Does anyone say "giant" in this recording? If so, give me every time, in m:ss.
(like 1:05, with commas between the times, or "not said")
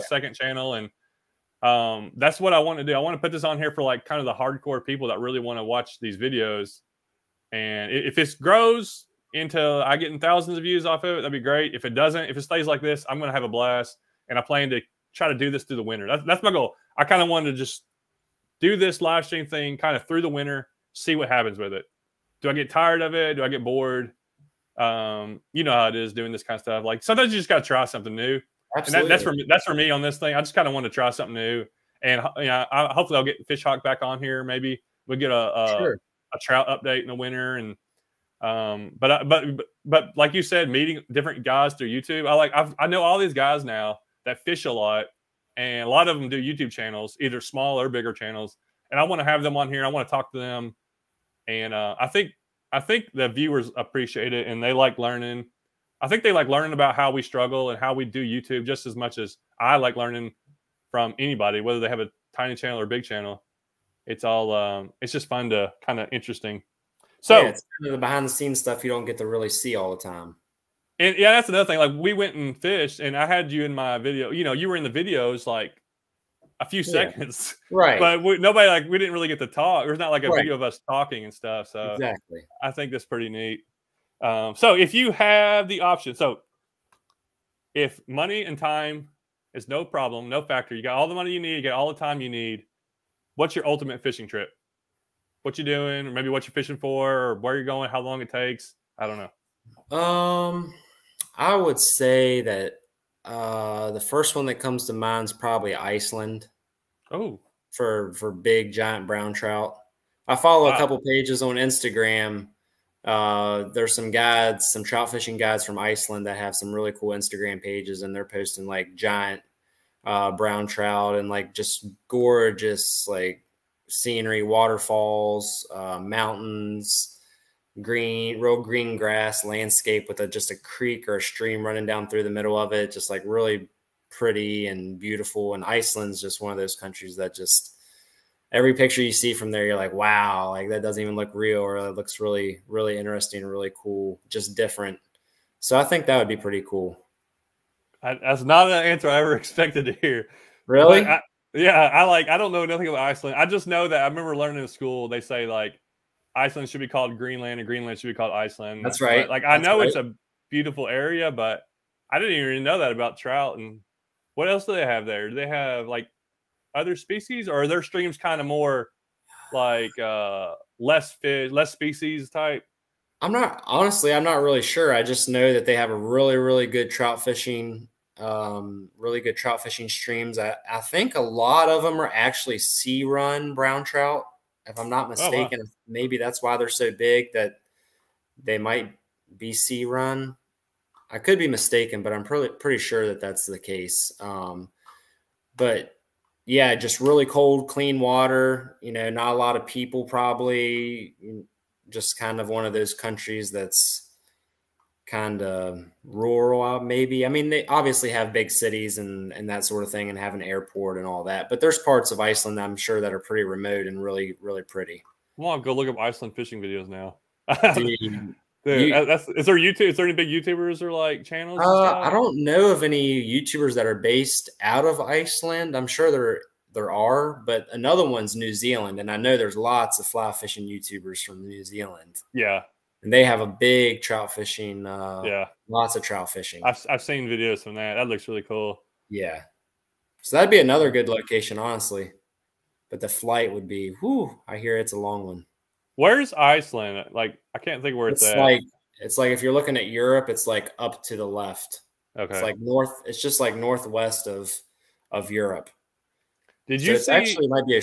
1:48, 1:58.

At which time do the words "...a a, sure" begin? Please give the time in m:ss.
0:35.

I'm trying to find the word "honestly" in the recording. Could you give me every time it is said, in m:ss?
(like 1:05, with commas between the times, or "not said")
2:53, 4:01.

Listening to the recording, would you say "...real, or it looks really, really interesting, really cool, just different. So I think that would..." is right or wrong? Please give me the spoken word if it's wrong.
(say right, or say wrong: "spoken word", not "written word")
right.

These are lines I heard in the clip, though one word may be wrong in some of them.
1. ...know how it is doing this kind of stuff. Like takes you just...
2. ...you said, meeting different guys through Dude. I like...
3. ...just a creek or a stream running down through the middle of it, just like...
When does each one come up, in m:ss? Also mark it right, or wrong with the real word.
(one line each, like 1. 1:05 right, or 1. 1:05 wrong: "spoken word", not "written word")
1. 0:25 wrong: "sometimes", not "takes"
2. 0:40 wrong: "YouTube", not "Dude"
3. 2:10 right.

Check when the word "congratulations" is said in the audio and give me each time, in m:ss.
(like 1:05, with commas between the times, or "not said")
not said.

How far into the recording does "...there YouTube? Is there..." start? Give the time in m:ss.
3:39.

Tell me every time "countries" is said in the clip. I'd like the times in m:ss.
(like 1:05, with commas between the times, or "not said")
2:16, 3:22.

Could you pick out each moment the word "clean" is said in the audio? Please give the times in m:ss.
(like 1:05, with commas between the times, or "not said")
3:17.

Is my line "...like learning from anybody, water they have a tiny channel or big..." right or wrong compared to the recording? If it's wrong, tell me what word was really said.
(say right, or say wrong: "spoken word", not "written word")
wrong: "whether", not "water".